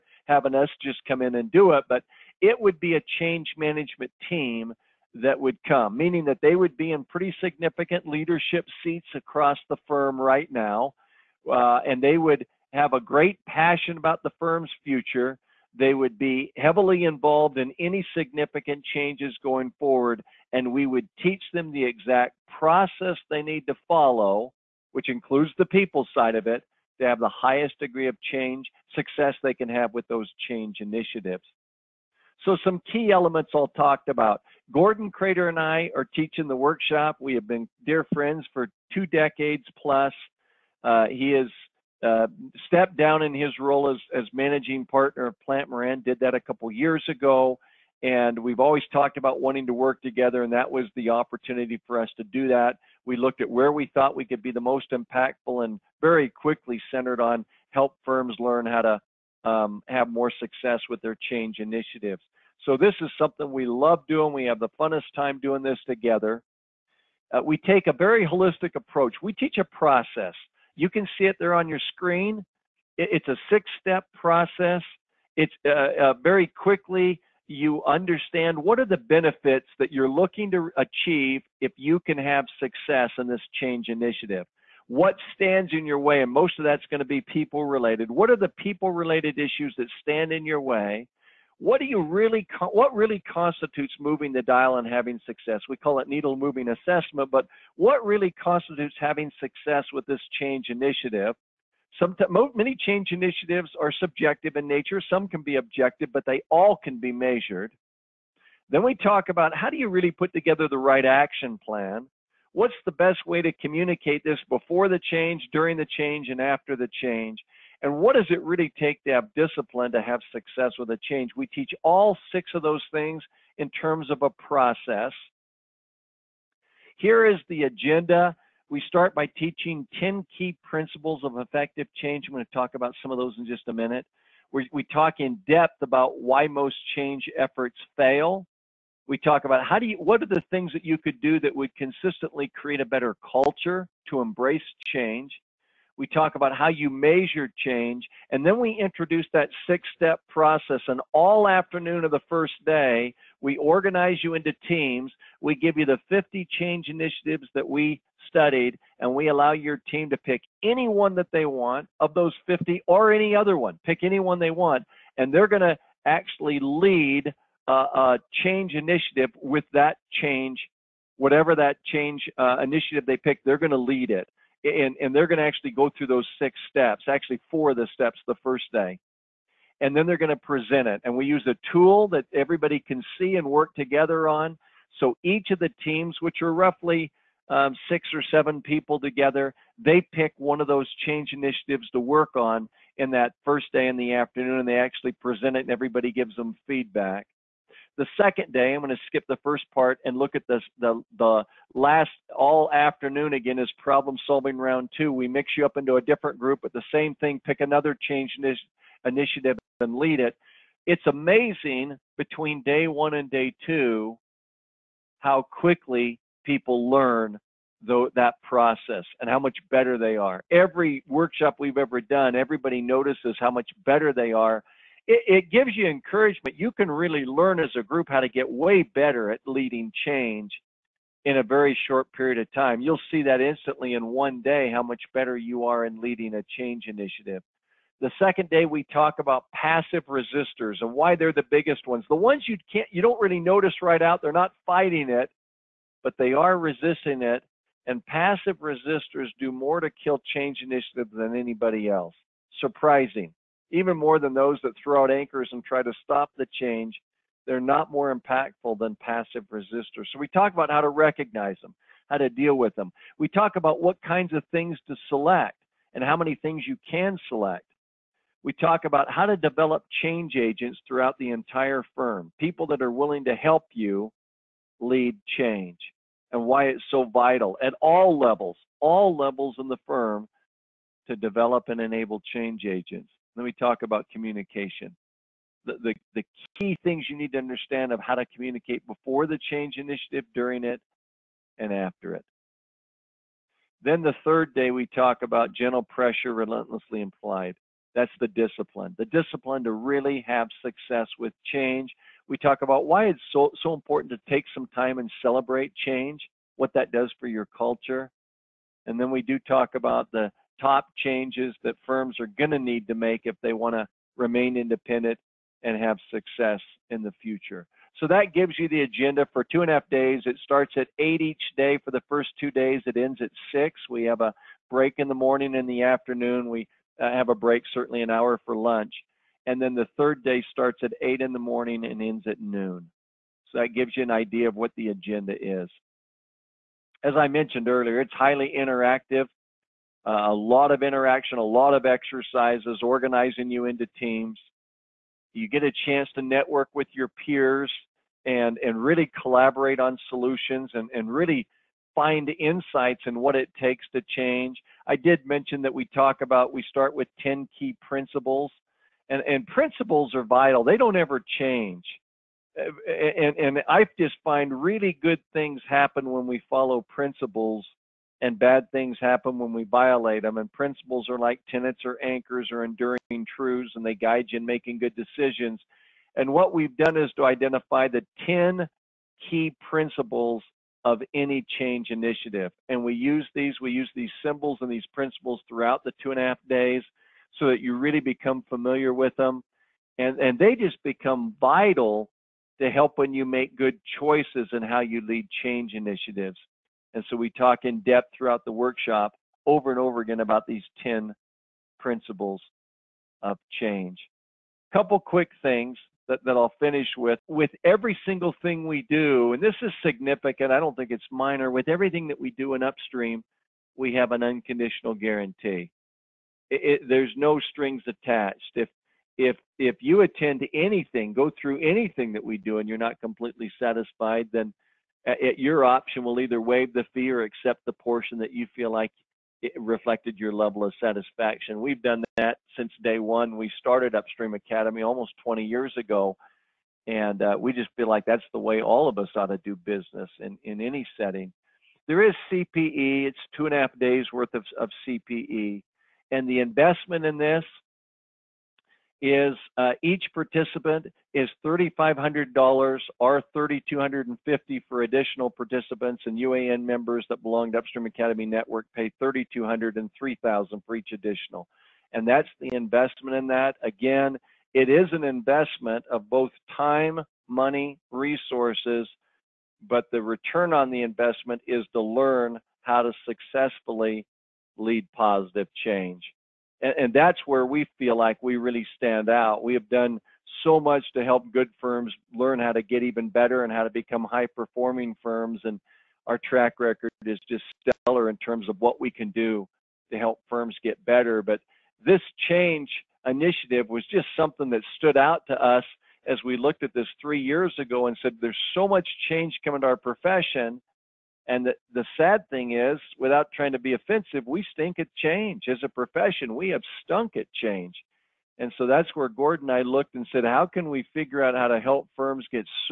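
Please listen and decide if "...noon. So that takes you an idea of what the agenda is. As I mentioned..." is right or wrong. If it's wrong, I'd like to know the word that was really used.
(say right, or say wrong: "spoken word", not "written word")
wrong: "gives", not "takes".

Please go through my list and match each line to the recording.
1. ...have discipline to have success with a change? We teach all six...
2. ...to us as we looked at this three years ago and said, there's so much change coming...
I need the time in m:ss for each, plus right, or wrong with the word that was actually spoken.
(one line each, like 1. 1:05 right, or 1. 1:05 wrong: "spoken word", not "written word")
1. 1:59 right
2. 8:15 right.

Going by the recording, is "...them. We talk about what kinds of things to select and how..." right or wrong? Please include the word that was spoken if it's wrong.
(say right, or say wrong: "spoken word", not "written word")
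right.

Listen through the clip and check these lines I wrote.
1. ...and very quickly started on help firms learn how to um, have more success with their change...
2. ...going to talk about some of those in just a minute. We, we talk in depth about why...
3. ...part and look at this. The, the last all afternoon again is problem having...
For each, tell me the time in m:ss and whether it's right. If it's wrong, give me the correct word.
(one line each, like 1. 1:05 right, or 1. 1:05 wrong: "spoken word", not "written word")
1. 0:55 wrong: "centered", not "started"
2. 2:12 right
3. 3:19 wrong: "solving", not "having".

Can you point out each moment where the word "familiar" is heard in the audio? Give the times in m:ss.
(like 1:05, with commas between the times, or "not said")
6:28.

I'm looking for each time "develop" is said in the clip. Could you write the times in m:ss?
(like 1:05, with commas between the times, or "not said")
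4:29, 4:41.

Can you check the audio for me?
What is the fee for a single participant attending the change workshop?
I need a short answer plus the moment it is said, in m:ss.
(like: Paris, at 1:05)
$3,500, at 7:31.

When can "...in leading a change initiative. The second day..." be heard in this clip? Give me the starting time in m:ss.
3:55.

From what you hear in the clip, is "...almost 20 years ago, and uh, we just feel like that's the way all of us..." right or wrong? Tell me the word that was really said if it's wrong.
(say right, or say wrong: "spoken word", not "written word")
right.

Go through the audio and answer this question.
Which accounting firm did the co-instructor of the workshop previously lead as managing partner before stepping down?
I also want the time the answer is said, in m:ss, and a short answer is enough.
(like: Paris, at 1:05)
Plante Moran, at 0:45.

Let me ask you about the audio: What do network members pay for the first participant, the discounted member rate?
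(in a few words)
$3,200.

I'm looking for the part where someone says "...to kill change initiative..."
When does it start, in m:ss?
4:09.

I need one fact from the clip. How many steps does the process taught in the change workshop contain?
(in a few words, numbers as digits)
6.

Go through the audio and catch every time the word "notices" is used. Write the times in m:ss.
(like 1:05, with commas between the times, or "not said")
3:42, 4:03.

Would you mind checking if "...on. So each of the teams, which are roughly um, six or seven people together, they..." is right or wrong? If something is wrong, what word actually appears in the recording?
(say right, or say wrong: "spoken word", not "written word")
right.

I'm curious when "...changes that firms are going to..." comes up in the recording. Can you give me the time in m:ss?
5:11.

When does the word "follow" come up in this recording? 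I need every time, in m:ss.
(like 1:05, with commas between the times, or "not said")
0:23, 6:06.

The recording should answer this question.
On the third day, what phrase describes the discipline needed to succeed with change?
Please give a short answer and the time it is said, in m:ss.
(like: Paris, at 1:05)
Gentle pressure relentlessly implied, at 4:55.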